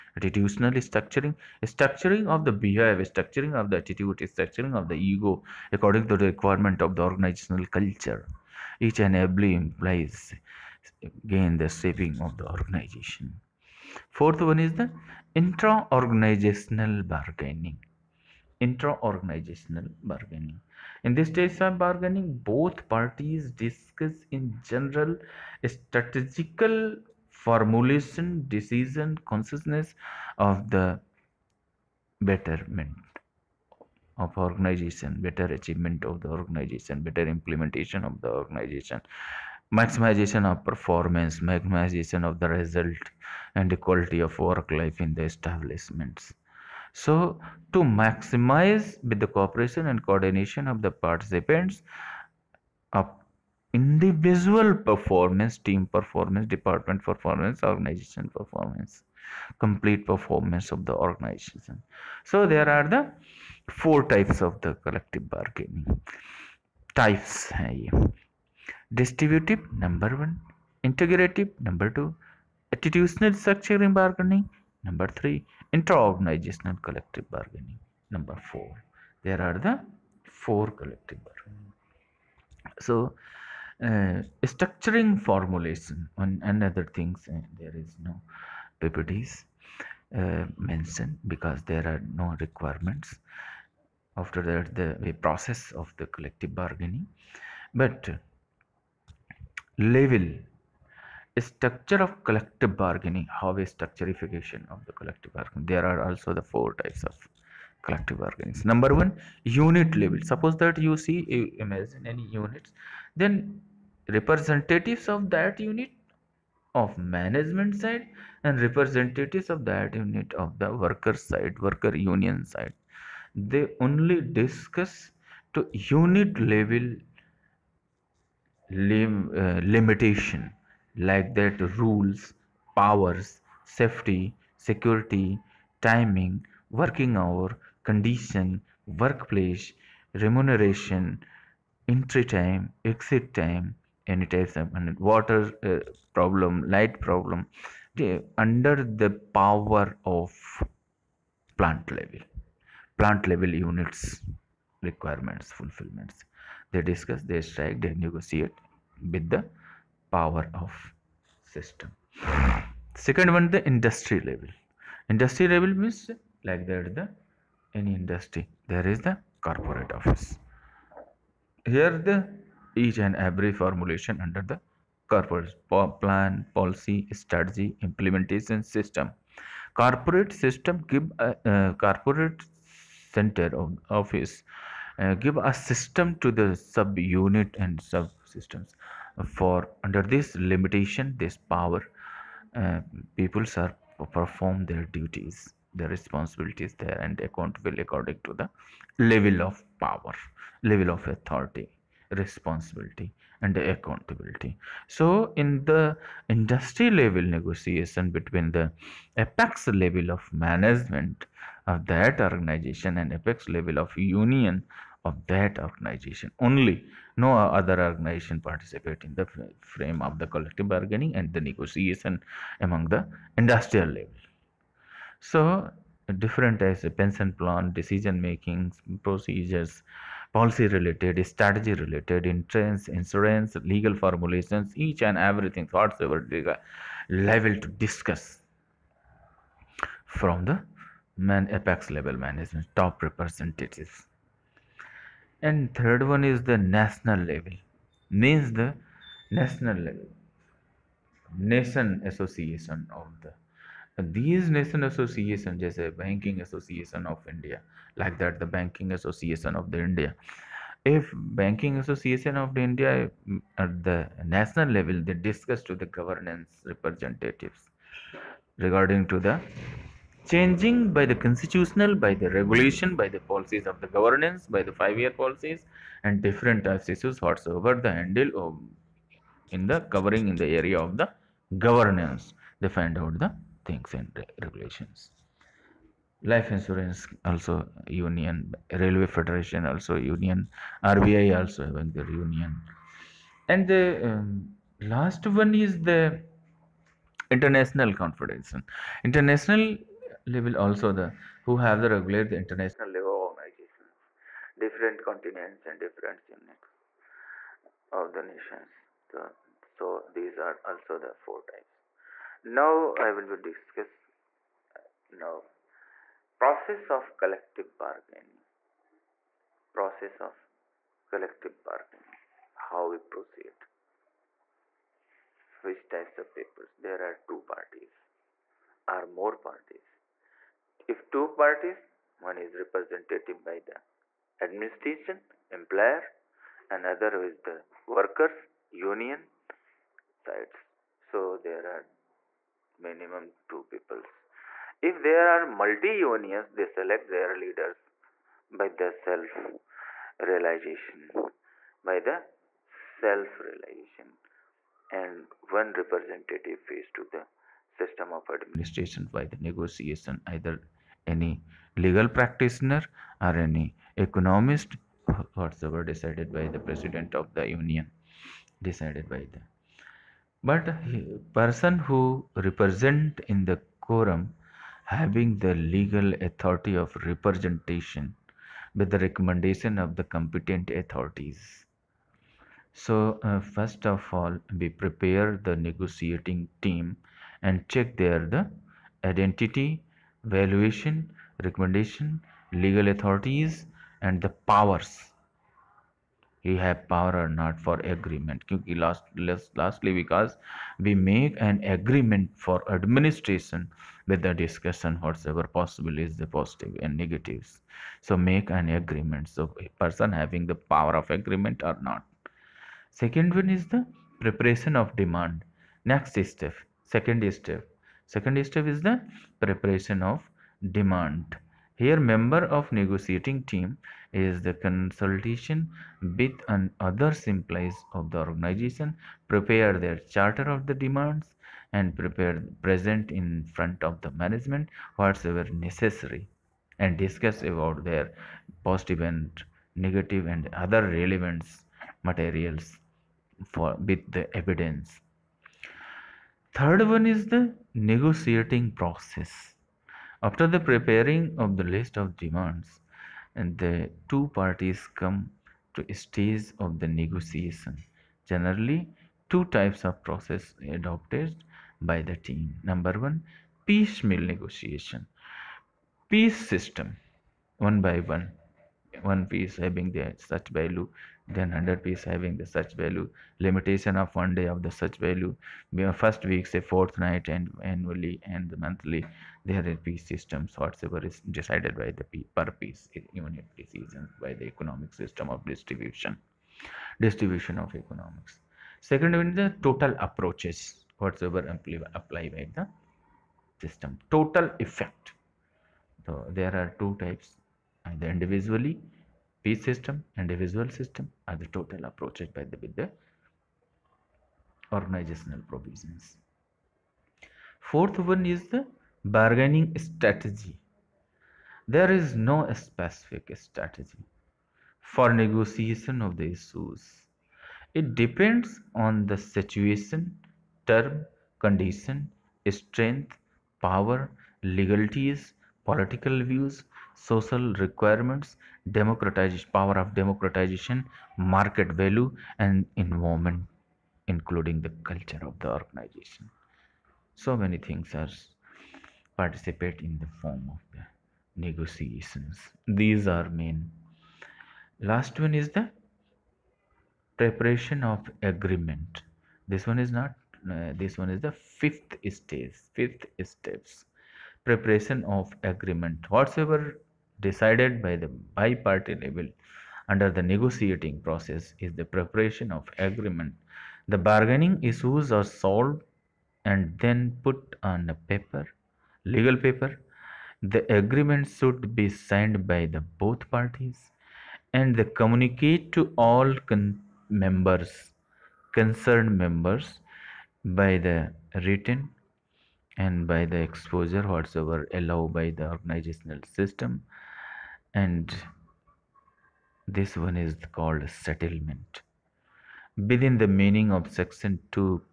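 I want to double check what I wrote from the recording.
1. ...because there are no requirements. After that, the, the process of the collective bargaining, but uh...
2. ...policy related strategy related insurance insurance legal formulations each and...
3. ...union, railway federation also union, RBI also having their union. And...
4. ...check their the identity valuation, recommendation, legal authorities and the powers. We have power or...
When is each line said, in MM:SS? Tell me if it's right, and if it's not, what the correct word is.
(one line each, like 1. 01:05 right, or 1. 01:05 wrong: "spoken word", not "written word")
1. 01:31 right
2. 03:50 right
3. 04:47 right
4. 06:27 right.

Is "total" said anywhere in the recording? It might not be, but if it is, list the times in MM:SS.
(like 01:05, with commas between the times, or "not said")
08:09, 08:14, 08:21.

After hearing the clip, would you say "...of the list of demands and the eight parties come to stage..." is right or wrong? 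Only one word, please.
wrong.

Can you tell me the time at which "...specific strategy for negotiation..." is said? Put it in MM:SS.
08:32.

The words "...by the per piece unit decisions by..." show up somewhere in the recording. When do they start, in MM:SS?
08:01.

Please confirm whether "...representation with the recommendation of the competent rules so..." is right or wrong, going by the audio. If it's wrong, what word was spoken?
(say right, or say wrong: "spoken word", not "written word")
wrong: "authorities", not "rules".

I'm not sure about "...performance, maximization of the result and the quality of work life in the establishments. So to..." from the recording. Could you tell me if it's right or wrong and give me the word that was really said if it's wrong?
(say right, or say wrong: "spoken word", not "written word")
right.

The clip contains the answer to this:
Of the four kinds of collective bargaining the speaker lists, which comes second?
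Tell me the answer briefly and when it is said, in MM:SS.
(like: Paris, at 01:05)
Integrative, at 01:10.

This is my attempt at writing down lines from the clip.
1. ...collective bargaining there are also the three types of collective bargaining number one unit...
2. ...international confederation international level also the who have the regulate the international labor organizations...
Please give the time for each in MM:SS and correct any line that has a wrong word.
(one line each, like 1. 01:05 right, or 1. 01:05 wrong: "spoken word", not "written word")
1. 01:44 wrong: "four", not "three"
2. 04:57 right.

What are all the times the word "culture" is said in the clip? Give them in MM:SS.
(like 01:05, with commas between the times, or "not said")
00:07, 08:54.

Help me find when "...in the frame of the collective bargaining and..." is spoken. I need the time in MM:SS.
03:39.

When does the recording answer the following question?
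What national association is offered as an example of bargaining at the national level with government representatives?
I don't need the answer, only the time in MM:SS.
04:16.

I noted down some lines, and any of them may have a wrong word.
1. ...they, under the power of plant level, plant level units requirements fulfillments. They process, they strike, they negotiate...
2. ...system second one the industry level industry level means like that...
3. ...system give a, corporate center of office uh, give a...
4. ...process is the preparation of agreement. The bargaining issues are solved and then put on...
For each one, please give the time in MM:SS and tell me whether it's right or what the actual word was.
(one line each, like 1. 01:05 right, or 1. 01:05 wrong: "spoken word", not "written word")
1. 02:27 wrong: "discuss", not "process"
2. 02:41 right
3. 03:00 right
4. 09:21 right.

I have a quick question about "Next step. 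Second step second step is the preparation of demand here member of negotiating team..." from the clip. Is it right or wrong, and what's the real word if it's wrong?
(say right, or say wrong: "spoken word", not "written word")
right.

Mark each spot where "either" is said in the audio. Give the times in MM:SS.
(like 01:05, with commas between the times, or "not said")
06:00, 08:17.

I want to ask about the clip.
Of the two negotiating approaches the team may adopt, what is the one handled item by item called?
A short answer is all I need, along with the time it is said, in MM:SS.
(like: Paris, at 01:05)
Piecemeal negotiation, at 07:43.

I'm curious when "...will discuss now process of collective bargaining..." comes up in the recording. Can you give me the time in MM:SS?
05:13.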